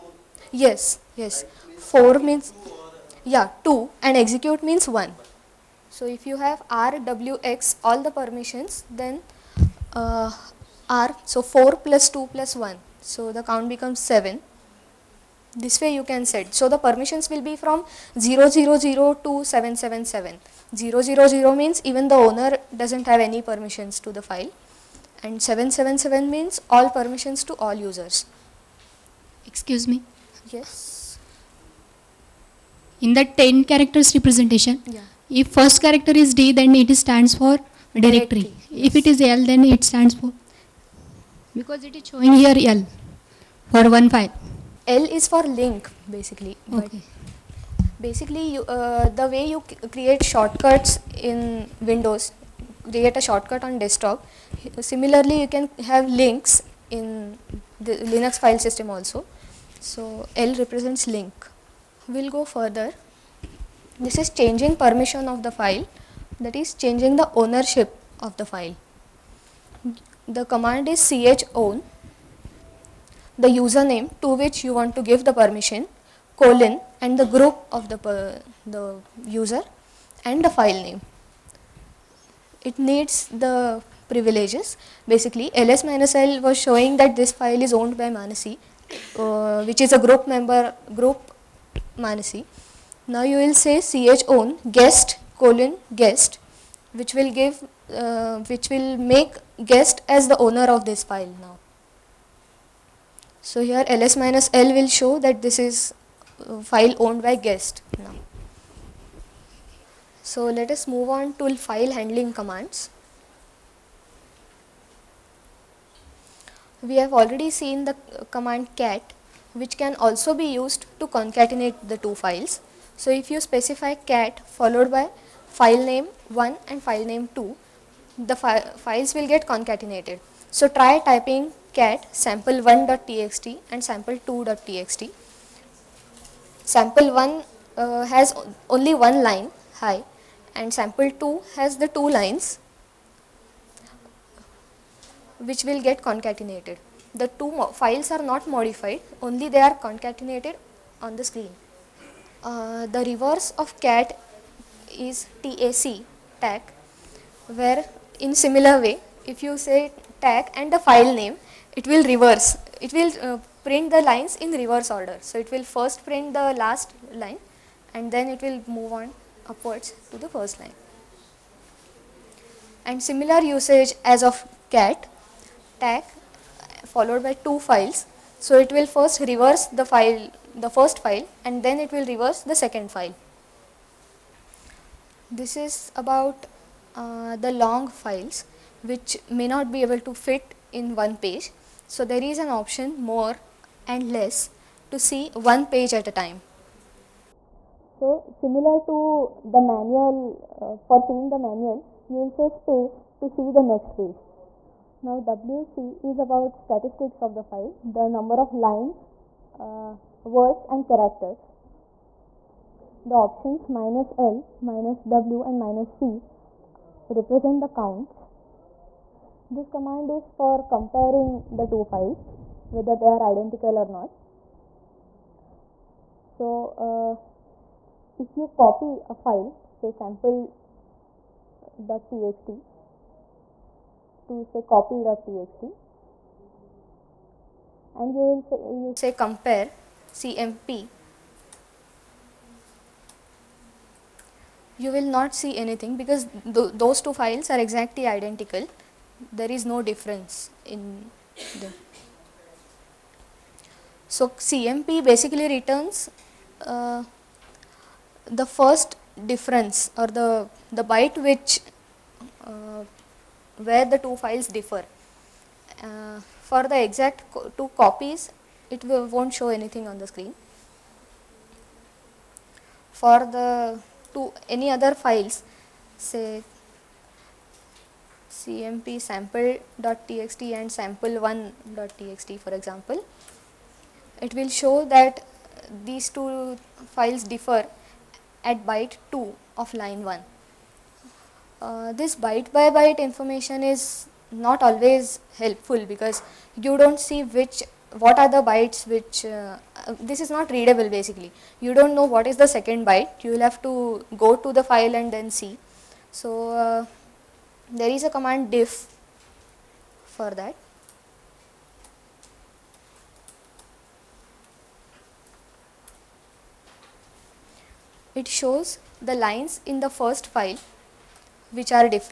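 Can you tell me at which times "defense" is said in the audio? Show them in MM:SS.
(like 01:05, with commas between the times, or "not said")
not said.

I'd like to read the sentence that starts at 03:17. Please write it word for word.
So similar to the manual, uh, for seeing the manual, you will say space to see the next page.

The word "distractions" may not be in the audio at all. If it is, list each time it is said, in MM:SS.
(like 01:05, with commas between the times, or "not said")
not said.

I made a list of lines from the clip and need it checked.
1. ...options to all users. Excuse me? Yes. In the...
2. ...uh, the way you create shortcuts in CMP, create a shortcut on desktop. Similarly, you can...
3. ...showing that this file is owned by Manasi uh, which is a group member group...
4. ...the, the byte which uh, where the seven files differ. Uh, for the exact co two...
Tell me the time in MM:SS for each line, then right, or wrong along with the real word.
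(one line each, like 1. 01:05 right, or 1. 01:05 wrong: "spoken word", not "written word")
1. 00:26 wrong: "permissions", not "options"
2. 00:48 wrong: "Windows", not "CMP"
3. 01:26 right
4. 04:20 wrong: "two", not "seven".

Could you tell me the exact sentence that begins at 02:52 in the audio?
And similar usage as of cat, tac followed by two files.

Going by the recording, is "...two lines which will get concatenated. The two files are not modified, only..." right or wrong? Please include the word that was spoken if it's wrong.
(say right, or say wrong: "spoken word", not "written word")
right.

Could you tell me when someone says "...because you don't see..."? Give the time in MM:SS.
04:55.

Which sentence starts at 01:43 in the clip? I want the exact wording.
So here ls minus l will show that this is uh, file owned by guest now.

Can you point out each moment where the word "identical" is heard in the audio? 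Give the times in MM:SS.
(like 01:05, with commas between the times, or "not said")
03:43, 04:08.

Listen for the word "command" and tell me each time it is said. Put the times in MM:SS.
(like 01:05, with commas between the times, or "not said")
01:10, 01:52, 01:58, 03:39, 05:08.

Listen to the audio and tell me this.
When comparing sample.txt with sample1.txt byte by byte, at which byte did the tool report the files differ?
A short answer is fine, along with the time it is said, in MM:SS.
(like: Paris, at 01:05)
2, at 04:48.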